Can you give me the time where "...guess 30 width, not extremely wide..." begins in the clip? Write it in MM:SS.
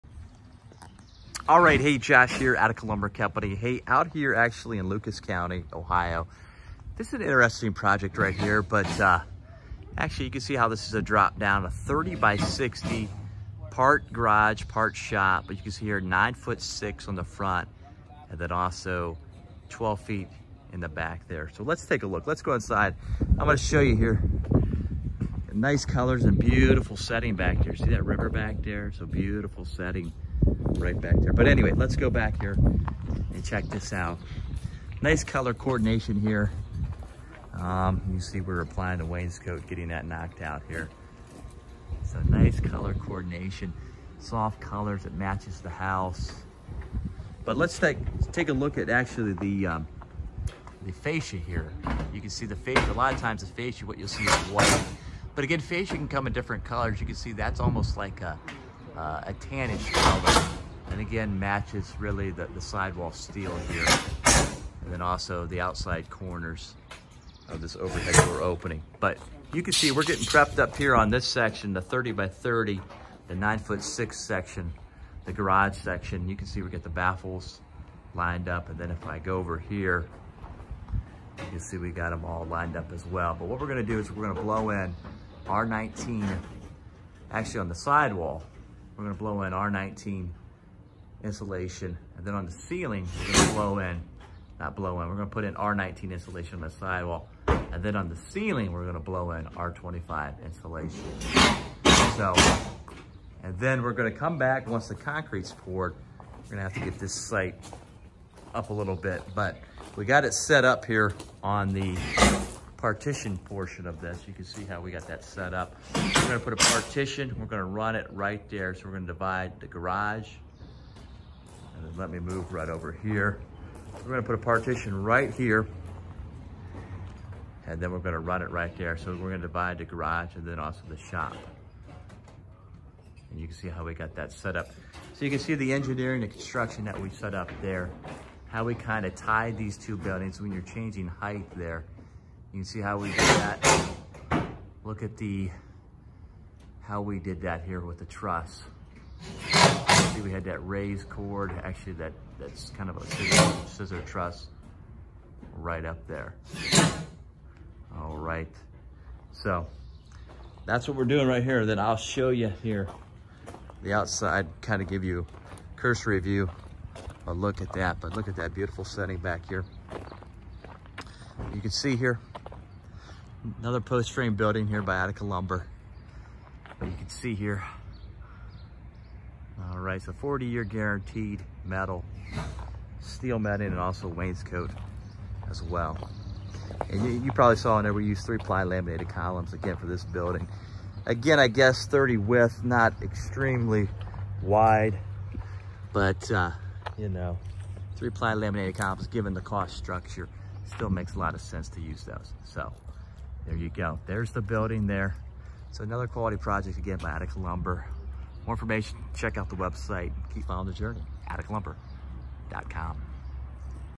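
03:11.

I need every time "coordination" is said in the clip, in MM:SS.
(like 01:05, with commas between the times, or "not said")
00:35, 00:42.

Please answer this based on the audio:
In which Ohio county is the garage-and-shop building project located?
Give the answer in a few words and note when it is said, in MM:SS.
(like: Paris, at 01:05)
Lucas County, at 00:04.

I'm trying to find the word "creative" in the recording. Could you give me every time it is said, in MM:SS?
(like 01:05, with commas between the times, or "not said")
not said.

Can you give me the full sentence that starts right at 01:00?
And again, matches really the, the sidewall steel here.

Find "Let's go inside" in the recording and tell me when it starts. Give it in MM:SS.
00:22.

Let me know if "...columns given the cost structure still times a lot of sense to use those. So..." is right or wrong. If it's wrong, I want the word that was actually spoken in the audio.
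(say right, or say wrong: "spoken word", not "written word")
wrong: "makes", not "times".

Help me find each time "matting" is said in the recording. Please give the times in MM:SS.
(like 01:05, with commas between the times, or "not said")
03:03.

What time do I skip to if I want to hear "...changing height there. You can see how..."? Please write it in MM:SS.
02:20.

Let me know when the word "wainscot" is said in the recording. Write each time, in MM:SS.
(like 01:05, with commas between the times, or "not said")
00:39, 03:04.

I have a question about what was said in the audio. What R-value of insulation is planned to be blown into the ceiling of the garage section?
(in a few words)
R25.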